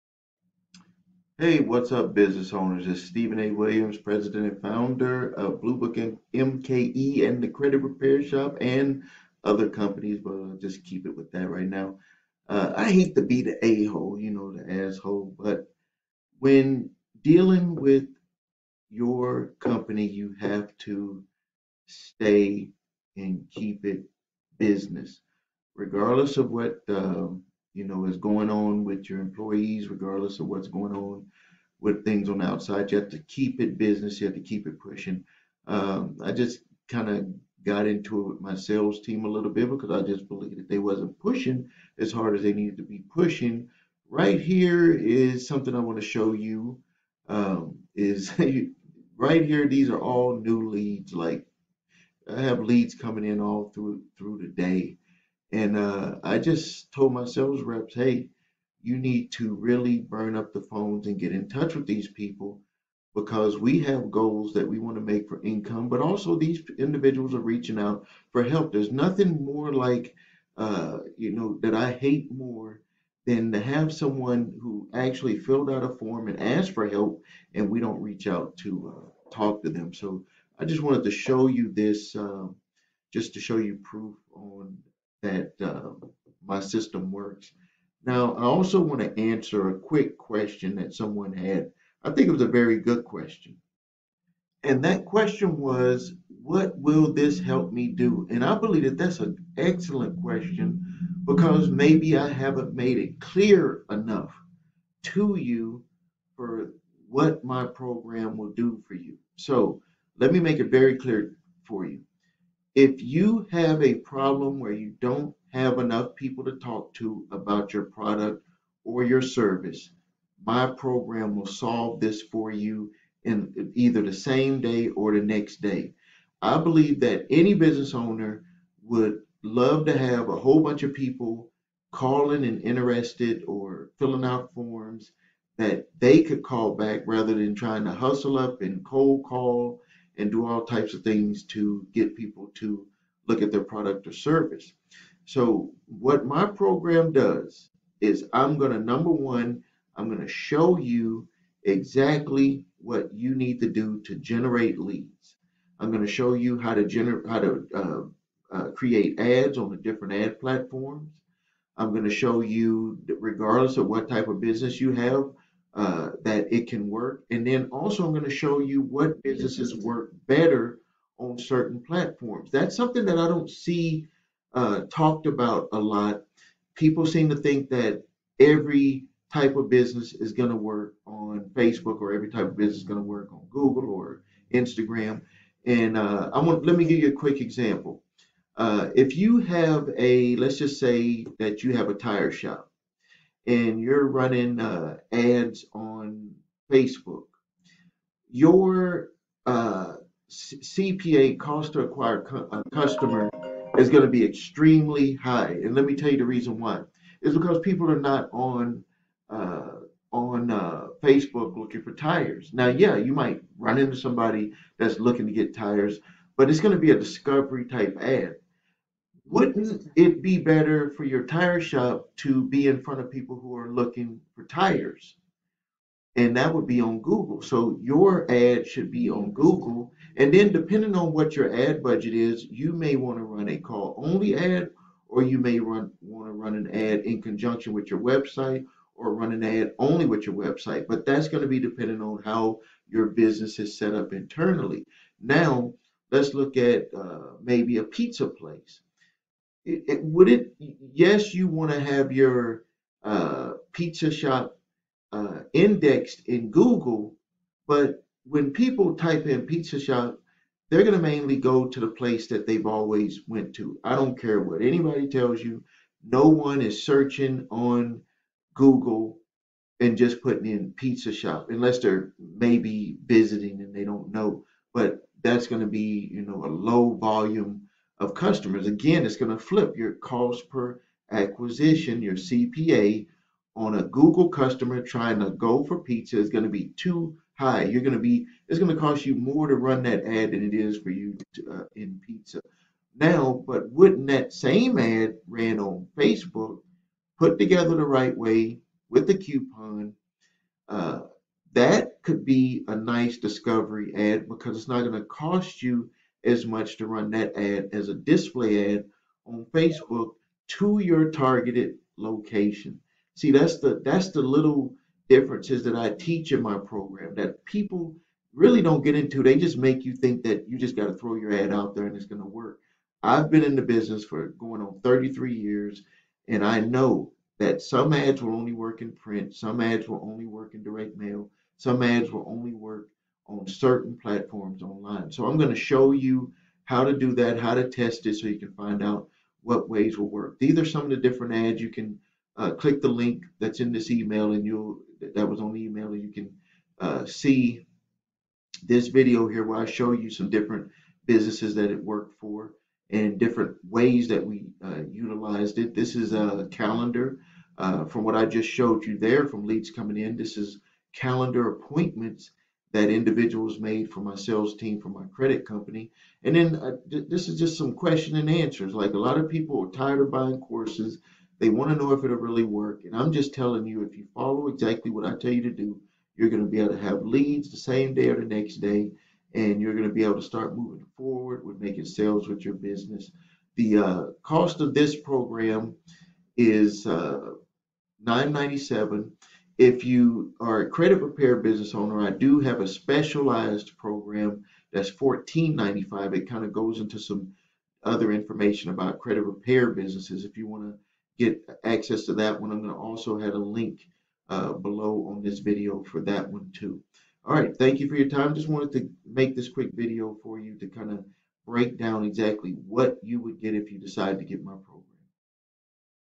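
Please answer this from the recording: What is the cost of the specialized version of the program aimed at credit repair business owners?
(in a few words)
$14.95.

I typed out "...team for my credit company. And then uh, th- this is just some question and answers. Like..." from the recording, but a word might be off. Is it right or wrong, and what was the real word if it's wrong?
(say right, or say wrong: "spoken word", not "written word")
right.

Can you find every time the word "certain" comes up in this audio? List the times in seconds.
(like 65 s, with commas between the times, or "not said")
171 s, 333 s.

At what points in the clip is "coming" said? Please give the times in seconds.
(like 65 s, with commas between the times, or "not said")
52 s, 359 s.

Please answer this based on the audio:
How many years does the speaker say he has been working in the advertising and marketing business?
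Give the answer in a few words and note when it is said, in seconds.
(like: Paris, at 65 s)
33 years, at 324 s.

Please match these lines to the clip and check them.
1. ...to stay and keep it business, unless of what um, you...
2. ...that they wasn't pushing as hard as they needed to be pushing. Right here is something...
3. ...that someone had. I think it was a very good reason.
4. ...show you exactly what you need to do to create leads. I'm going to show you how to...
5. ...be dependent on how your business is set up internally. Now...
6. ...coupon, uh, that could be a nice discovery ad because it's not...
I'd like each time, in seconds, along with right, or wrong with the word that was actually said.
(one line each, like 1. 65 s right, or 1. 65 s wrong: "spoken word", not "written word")
1. 20 s wrong: "regardless", not "unless"
2. 40 s right
3. 90 s wrong: "question", not "reason"
4. 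150 s wrong: "generate", not "create"
5. 241 s right
6. 299 s right.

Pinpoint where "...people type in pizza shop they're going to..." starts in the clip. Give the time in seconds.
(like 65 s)
258 s.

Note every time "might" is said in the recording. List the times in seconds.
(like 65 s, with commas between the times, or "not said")
213 s.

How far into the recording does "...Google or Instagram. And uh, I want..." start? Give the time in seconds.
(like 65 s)
183 s.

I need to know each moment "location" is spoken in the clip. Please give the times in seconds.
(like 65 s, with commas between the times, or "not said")
311 s.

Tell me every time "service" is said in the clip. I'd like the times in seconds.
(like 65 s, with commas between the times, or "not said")
119 s, 144 s.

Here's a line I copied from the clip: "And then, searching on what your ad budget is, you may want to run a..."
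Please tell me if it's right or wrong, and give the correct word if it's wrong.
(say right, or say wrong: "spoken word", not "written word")
wrong: "depending", not "searching".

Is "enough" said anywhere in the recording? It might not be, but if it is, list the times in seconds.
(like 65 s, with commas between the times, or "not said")
103 s, 115 s.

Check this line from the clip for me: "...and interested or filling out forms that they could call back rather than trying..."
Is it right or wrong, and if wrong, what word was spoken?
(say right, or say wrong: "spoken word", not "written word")
right.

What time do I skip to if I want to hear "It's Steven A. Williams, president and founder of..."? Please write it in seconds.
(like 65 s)
2 s.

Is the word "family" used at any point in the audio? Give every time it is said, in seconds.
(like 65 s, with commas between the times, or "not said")
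not said.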